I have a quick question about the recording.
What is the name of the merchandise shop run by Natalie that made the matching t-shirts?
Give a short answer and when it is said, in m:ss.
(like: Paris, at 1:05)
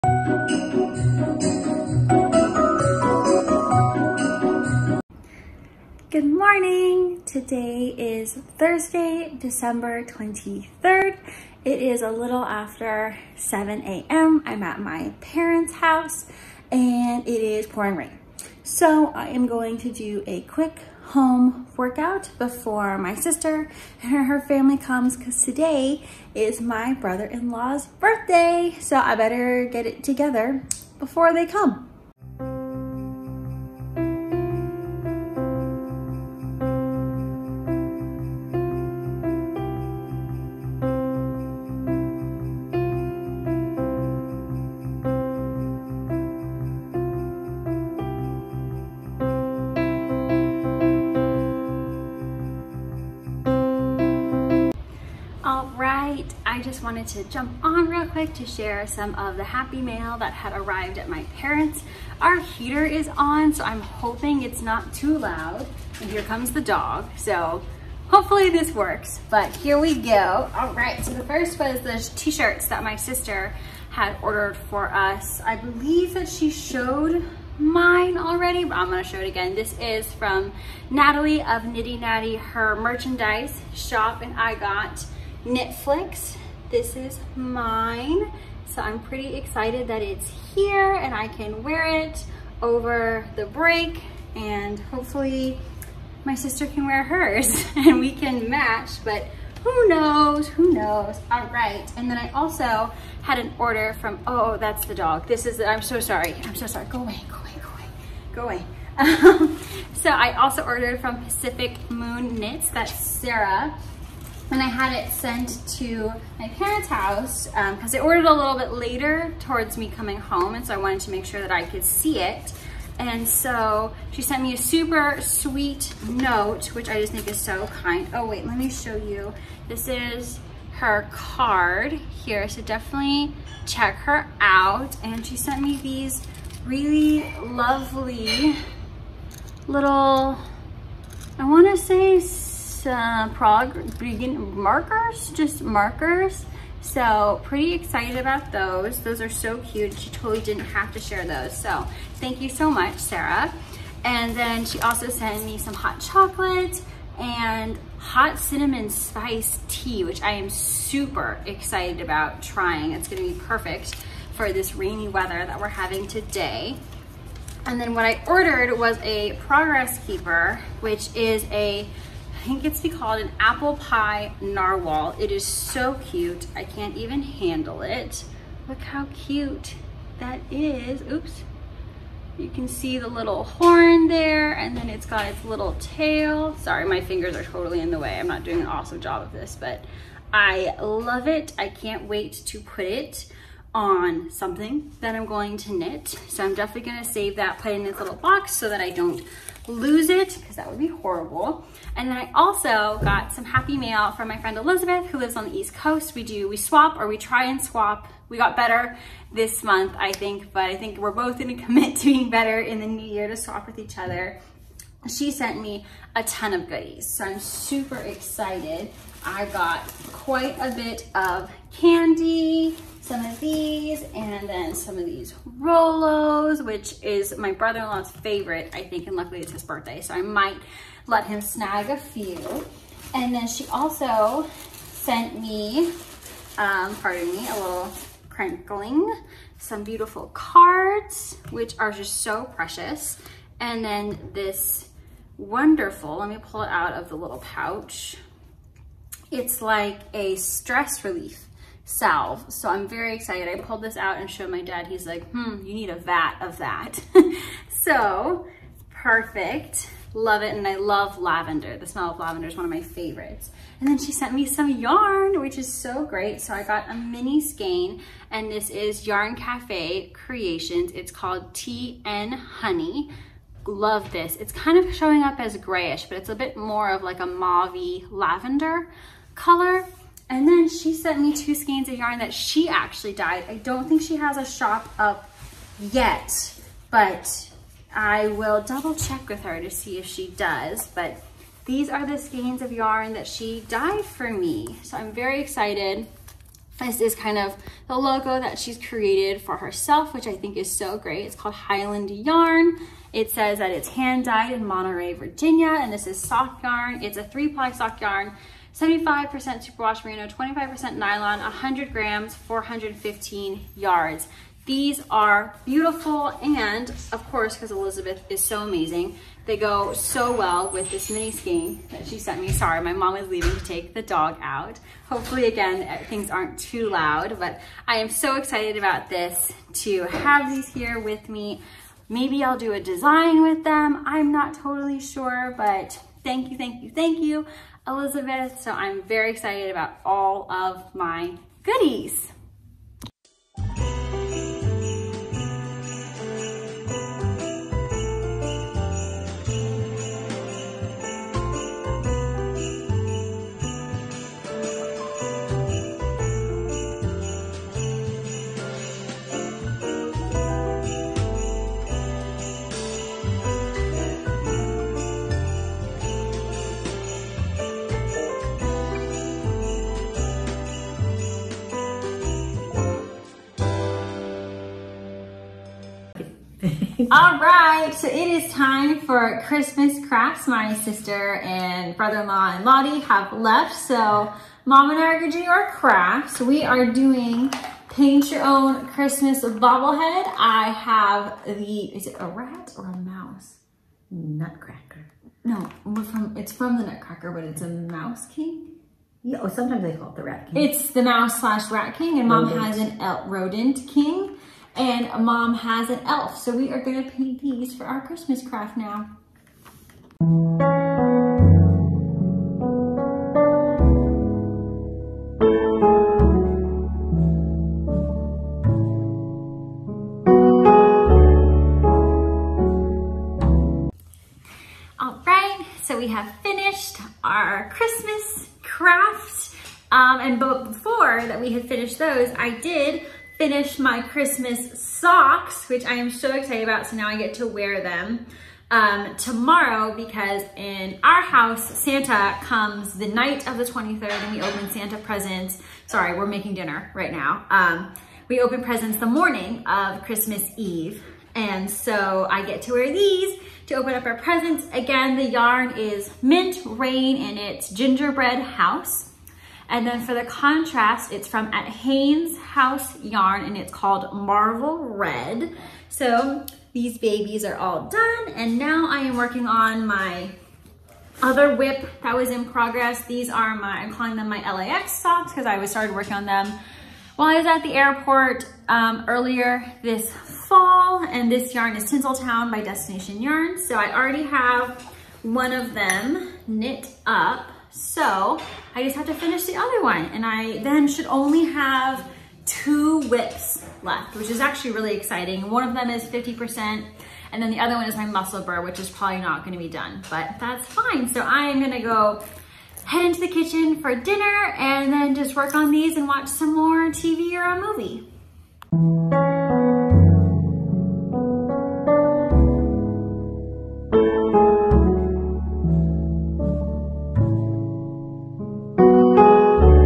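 Nitty Natty, at 1:21.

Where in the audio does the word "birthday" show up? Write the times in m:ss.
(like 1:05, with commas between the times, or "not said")
0:27, 3:49.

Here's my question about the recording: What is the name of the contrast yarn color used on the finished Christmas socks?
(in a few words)
Marvel Red.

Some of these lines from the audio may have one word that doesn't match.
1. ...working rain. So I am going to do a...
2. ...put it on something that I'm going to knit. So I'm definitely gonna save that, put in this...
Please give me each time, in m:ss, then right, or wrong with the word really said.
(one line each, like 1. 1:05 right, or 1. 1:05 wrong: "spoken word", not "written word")
1. 0:17 wrong: "pouring", not "working"
2. 3:12 right.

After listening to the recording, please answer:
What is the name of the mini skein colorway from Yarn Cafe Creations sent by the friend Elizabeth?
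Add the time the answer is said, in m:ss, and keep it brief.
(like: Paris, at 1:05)
TN Honey, at 4:31.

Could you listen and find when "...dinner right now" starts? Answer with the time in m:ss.
7:26.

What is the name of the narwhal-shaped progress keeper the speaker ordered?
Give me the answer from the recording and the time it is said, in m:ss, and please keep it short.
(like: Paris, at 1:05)
Apple pie narwhal, at 2:53.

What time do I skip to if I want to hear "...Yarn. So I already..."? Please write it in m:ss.
8:03.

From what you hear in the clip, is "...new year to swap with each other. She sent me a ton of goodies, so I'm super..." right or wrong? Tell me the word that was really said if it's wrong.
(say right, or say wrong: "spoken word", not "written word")
right.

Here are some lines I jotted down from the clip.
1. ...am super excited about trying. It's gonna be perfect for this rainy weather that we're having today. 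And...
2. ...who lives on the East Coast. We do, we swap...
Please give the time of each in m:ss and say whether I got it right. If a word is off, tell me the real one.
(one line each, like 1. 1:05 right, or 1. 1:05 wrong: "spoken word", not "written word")
1. 2:40 right
2. 3:25 right.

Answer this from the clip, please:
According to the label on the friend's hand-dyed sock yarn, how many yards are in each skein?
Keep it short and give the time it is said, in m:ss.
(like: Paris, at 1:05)
415 yards, at 5:12.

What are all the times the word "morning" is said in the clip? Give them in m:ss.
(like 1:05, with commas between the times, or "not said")
0:06, 7:29.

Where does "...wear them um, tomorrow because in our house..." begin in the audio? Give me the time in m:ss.
7:17.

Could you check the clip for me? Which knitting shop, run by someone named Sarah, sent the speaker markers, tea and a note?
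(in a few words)
Pacific Moon Knits.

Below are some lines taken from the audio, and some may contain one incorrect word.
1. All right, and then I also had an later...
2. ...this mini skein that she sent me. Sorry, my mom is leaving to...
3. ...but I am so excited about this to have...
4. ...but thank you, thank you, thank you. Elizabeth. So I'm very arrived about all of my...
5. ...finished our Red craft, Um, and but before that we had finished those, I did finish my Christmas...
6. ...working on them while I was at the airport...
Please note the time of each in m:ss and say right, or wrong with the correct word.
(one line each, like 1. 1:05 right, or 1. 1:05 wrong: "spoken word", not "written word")
1. 1:41 wrong: "order", not "later"
2. 5:20 right
3. 5:27 right
4. 5:35 wrong: "excited", not "arrived"
5. 7:06 wrong: "Christmas", not "Red"
6. 7:55 right.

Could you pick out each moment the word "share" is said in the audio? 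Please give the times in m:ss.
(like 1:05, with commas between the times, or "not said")
0:58, 2:30.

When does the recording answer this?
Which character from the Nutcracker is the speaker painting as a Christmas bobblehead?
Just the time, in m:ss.
6:37.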